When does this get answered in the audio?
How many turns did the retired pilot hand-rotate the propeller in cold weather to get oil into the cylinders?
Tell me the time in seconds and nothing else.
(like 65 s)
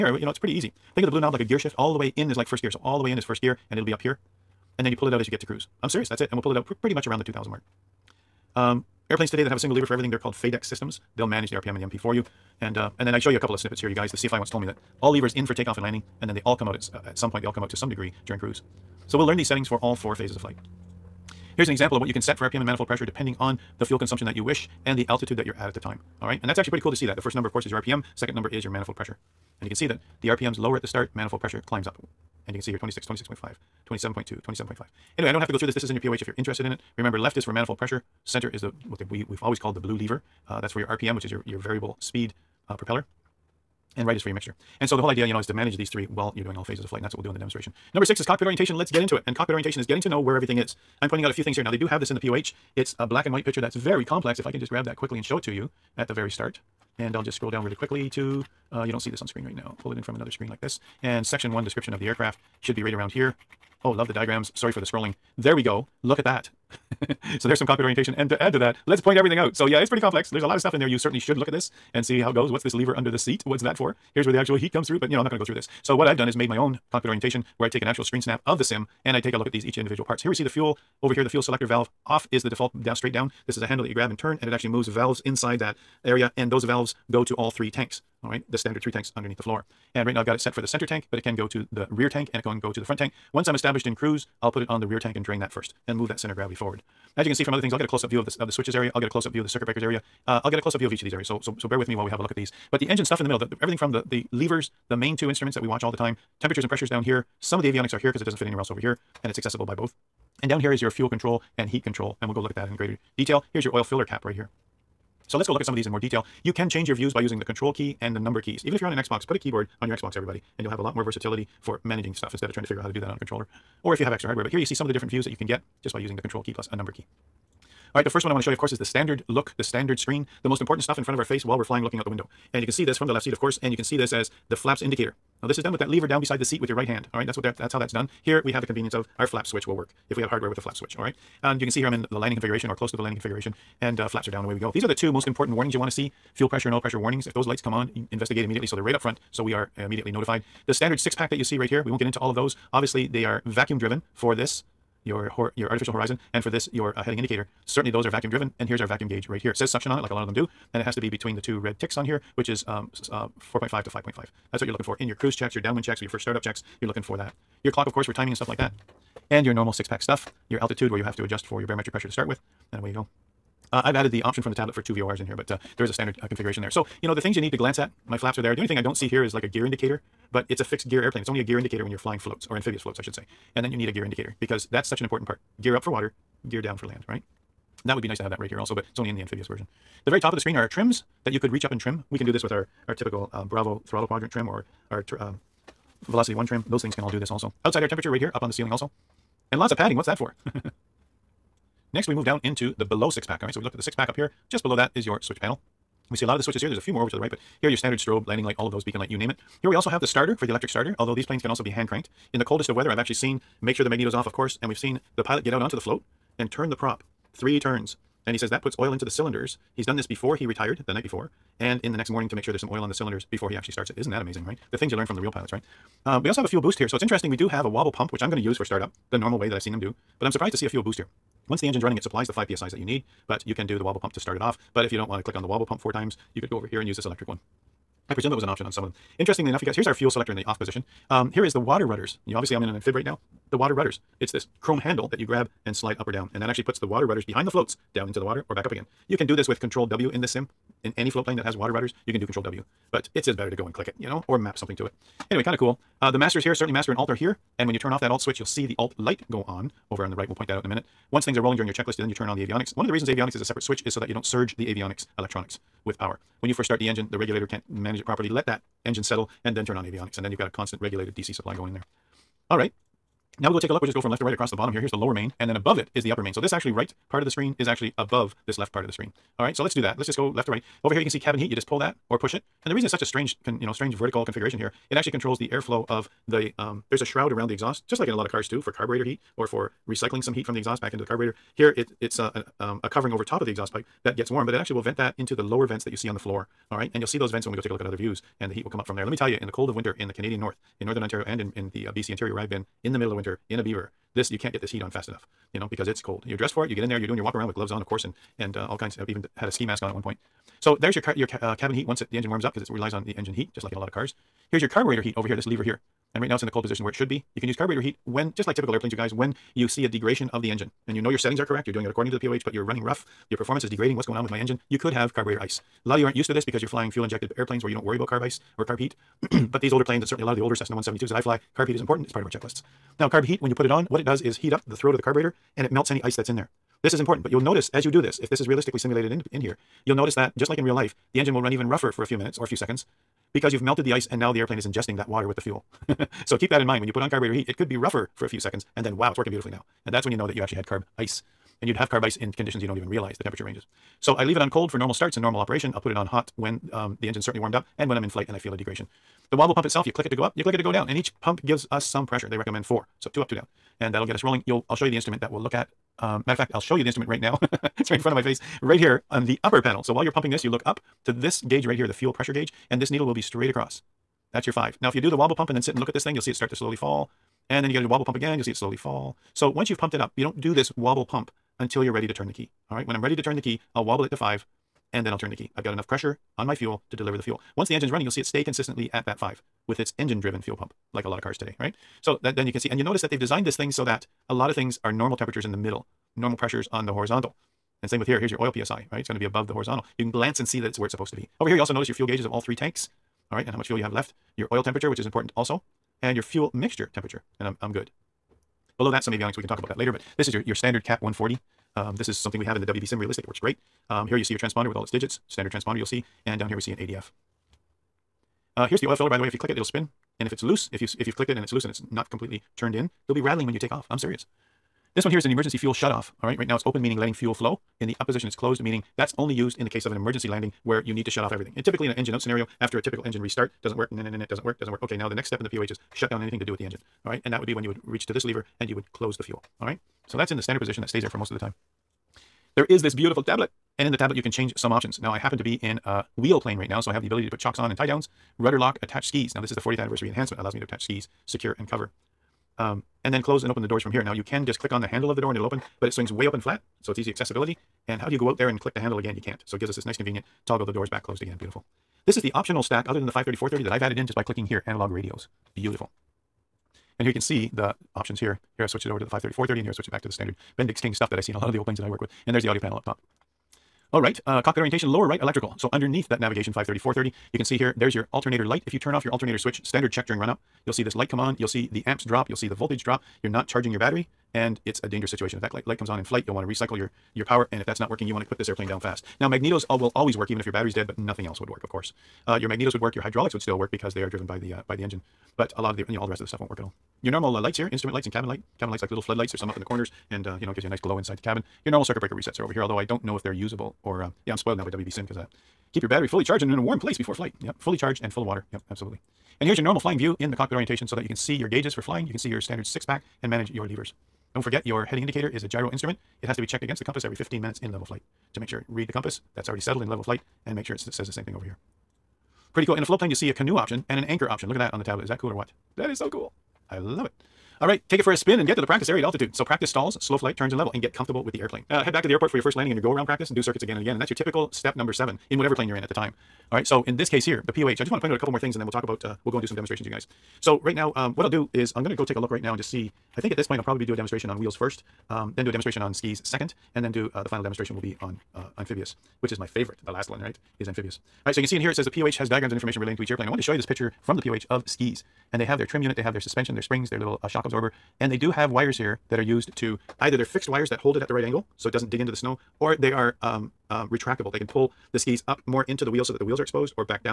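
217 s.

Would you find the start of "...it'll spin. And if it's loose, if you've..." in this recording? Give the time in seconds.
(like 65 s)
419 s.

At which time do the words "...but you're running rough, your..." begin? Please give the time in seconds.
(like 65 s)
322 s.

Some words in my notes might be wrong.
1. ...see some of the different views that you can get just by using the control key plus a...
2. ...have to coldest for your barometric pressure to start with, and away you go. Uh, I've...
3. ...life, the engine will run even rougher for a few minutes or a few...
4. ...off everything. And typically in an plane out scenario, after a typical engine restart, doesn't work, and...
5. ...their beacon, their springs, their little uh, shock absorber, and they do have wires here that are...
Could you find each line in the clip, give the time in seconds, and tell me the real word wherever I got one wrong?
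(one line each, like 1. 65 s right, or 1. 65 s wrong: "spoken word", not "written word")
1. 124 s right
2. 171 s wrong: "adjust", not "coldest"
3. 340 s right
4. 431 s wrong: "engine", not "plane"
5. 556 s wrong: "suspension", not "beacon".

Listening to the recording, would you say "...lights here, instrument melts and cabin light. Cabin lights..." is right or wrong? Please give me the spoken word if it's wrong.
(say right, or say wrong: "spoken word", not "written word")
wrong: "lights", not "melts".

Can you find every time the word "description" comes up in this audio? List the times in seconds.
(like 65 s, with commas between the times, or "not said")
61 s.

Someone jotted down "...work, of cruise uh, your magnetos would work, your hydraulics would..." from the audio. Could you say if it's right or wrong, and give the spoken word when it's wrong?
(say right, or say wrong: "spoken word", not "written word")
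wrong: "course", not "cruise".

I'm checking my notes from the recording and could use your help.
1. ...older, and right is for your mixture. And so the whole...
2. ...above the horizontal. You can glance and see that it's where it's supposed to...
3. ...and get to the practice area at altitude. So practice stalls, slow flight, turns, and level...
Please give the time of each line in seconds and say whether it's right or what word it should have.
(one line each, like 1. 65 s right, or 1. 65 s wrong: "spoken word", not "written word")
1. 42 s wrong: "propeller", not "older"
2. 399 s right
3. 528 s right.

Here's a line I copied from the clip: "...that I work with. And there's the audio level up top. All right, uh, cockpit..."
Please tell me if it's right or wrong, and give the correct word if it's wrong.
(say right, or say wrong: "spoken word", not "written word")
wrong: "panel", not "level".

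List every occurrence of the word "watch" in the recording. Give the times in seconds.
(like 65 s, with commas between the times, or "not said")
105 s.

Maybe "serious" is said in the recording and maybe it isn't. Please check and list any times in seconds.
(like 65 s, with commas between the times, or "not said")
5 s, 423 s.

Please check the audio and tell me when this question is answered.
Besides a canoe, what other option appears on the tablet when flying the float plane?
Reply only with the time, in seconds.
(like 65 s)
524 s.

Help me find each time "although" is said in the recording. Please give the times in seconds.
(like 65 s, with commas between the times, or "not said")
210 s, 502 s.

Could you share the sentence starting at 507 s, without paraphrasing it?
Yep, fully charged and full of water.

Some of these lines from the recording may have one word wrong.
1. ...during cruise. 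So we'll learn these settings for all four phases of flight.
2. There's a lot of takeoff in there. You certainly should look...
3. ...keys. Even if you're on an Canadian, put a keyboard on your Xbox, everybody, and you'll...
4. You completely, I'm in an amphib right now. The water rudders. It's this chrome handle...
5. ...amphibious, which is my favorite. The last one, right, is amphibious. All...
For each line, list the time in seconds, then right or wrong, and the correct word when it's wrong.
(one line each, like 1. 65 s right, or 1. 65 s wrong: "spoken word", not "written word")
1. 18 s right
2. 70 s wrong: "stuff", not "takeoff"
3. 118 s wrong: "Xbox", not "Canadian"
4. 242 s wrong: "obviously", not "completely"
5. 548 s right.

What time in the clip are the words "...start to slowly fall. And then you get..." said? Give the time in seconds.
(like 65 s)
376 s.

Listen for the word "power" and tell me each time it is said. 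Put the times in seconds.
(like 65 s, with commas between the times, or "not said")
265 s, 487 s.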